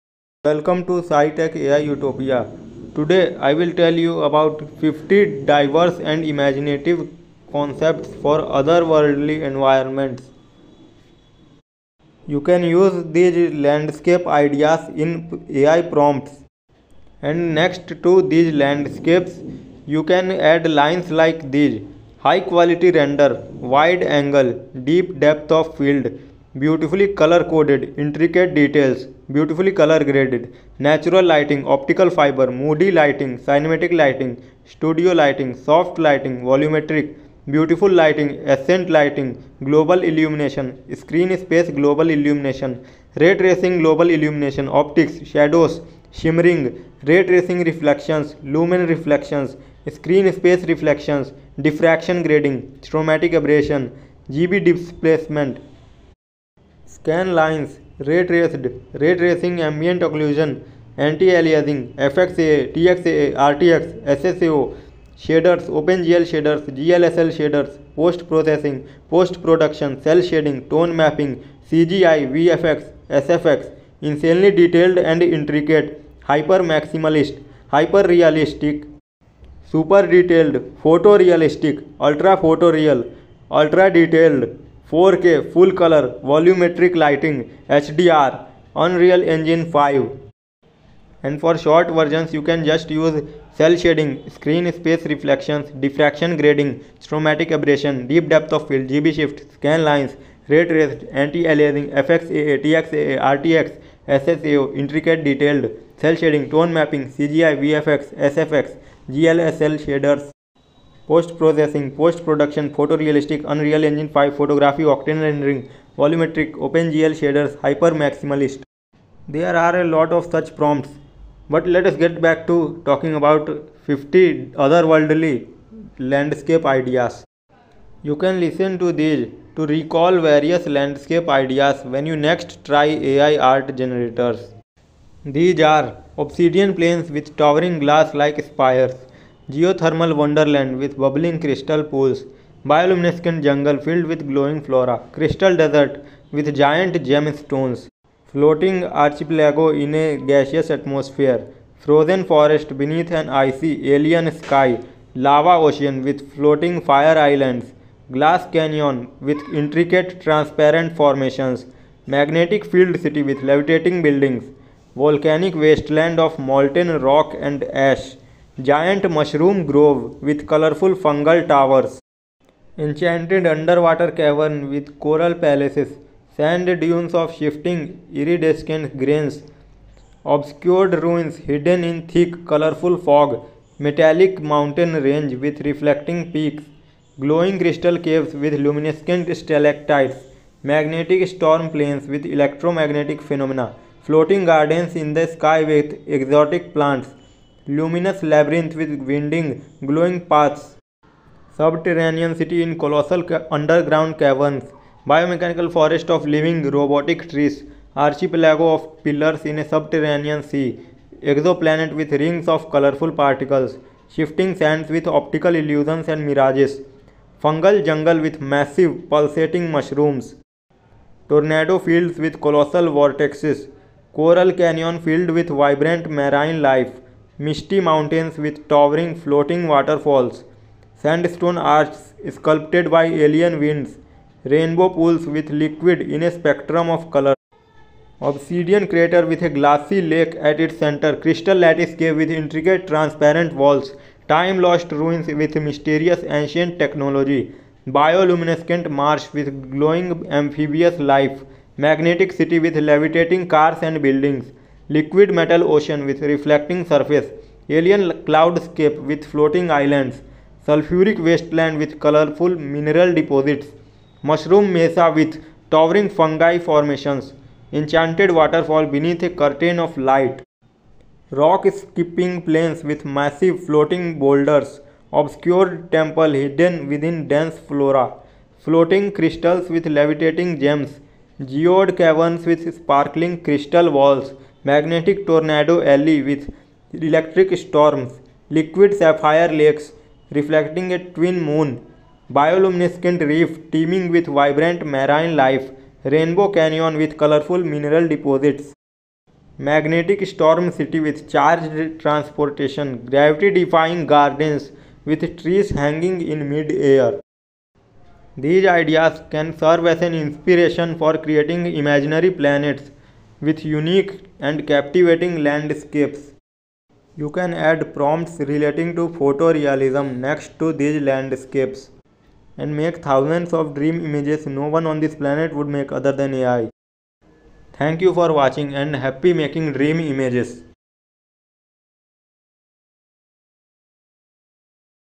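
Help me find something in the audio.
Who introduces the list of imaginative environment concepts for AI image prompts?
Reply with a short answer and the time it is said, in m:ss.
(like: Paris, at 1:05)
SciTech AI Utopia, at 0:01.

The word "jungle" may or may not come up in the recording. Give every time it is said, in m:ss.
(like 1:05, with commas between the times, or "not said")
2:23, 3:37.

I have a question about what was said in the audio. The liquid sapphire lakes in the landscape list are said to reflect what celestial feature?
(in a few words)
A twin moon.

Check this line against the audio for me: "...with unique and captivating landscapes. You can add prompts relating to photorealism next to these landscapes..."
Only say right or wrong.
right.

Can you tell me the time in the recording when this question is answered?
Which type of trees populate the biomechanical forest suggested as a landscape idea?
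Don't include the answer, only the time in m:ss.
3:26.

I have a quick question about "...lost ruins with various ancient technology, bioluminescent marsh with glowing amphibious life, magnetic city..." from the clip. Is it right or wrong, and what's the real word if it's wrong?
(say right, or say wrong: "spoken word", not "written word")
wrong: "mysterious", not "various".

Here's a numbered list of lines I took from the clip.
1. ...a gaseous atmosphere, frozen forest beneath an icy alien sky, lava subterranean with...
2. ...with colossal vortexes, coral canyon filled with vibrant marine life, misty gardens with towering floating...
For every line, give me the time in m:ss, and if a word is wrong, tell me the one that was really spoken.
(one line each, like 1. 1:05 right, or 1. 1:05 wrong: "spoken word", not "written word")
1. 2:30 wrong: "ocean", not "subterranean"
2. 3:42 wrong: "mountains", not "gardens".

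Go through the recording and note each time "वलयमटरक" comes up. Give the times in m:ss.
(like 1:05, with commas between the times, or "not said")
1:26.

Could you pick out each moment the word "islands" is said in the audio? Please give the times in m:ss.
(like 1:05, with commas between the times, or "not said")
2:37, 4:19.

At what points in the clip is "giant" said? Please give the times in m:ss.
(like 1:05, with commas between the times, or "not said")
2:26, 2:48.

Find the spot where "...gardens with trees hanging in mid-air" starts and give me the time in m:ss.
5:04.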